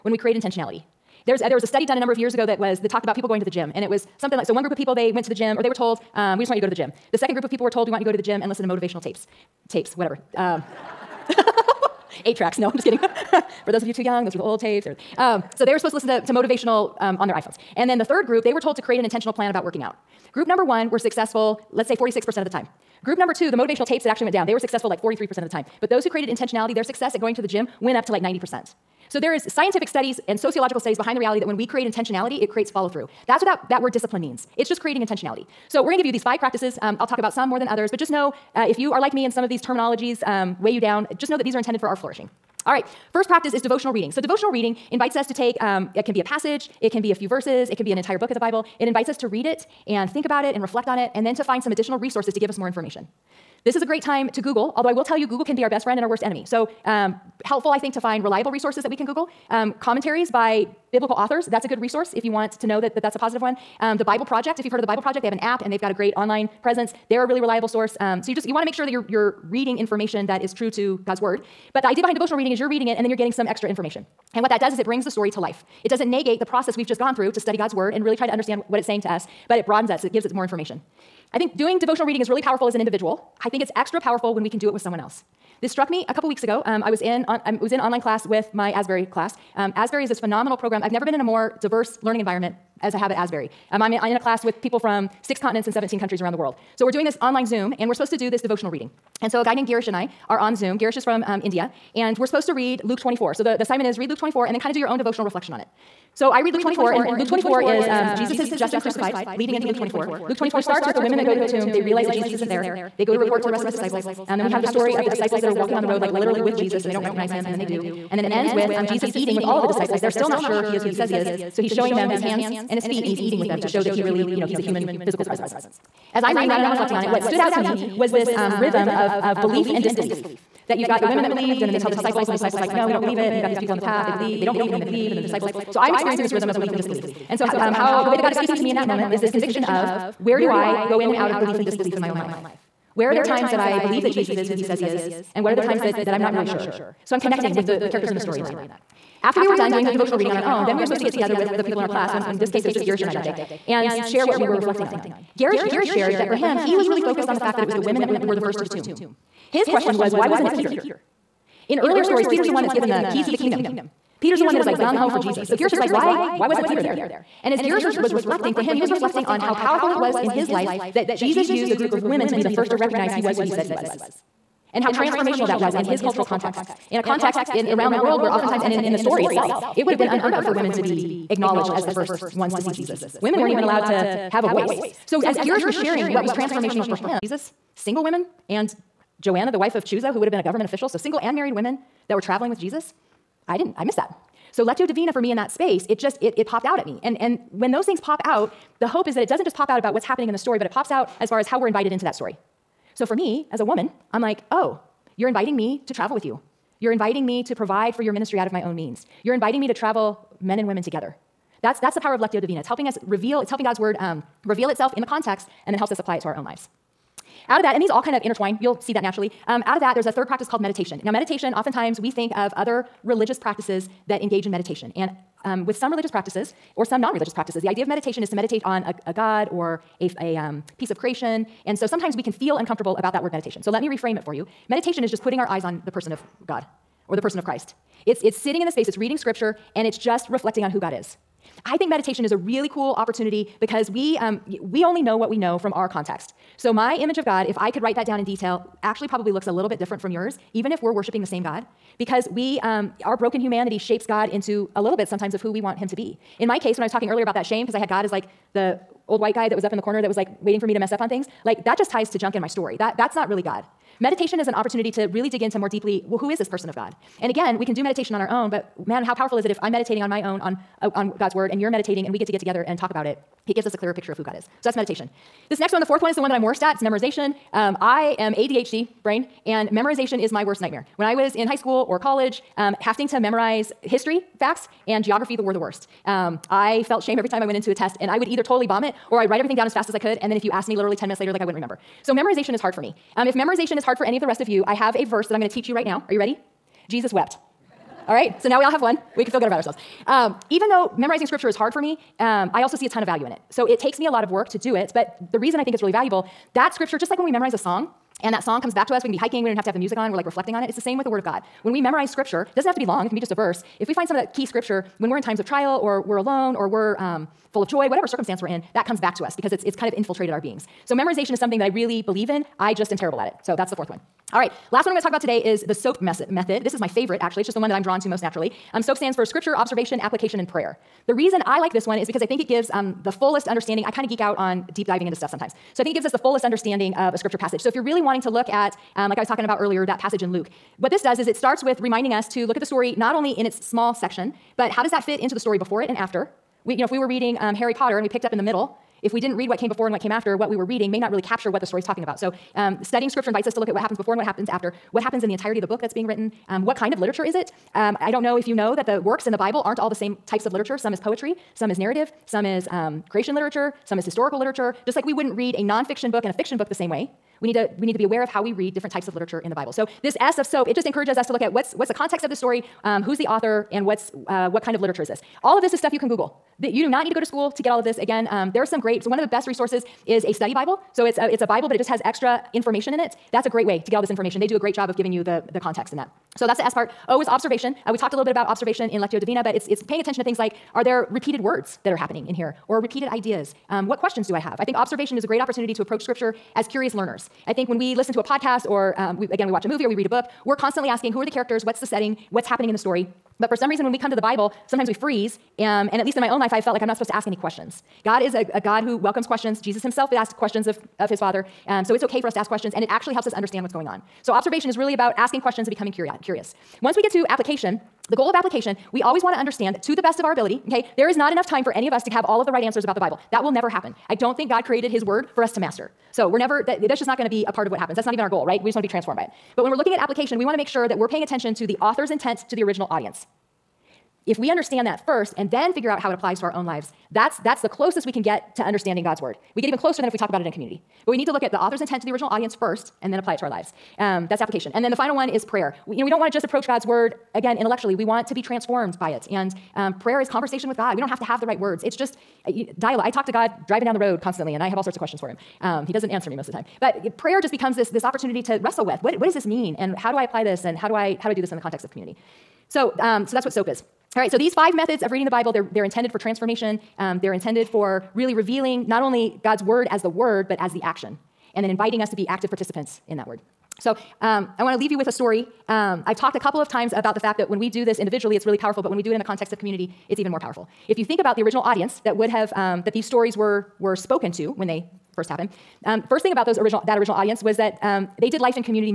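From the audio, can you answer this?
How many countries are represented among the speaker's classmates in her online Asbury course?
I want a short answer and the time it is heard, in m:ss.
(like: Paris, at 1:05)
17, at 1:35.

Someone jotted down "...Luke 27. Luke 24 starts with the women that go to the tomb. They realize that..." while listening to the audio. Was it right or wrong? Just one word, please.
wrong.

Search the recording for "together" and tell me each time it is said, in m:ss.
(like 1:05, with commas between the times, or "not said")
2:31, 3:30, 4:32.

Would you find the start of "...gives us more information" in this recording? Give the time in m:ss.
1:20.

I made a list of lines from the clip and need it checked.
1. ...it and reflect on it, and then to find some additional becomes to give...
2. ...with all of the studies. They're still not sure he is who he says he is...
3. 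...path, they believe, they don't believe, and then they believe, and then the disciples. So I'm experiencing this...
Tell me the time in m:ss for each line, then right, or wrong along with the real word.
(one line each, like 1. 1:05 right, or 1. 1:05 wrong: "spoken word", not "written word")
1. 0:50 wrong: "resources", not "becomes"
2. 1:59 wrong: "disciples", not "studies"
3. 2:13 right.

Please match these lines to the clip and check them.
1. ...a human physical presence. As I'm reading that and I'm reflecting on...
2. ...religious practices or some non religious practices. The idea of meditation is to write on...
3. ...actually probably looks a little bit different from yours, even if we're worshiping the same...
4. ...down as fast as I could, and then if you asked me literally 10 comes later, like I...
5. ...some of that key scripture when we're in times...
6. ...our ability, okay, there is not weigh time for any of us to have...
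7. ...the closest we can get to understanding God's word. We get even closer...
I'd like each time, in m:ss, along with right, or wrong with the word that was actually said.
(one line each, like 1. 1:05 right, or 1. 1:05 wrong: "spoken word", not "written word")
1. 2:04 right
2. 3:45 wrong: "meditate", not "write"
3. 4:08 right
4. 4:49 wrong: "minutes", not "comes"
5. 5:14 right
6. 7:00 wrong: "enough", not "weigh"
7. 7:17 right.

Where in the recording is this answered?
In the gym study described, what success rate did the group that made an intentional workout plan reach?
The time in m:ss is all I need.
0:28.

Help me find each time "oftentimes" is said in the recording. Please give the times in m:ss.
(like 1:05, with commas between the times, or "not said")
2:58, 3:41.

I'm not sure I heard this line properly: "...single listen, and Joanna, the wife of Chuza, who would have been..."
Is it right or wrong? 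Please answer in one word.
wrong.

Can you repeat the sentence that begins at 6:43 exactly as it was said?
But for some reason, when we come to the Bible, sometimes we freeze.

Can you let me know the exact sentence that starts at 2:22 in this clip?
Where are there times that I believe that Jesus is who he says he is?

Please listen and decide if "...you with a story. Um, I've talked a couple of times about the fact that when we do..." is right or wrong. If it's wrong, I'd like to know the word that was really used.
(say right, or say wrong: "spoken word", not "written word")
right.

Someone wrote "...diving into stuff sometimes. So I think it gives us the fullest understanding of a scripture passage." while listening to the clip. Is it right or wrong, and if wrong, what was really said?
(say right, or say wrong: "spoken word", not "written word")
right.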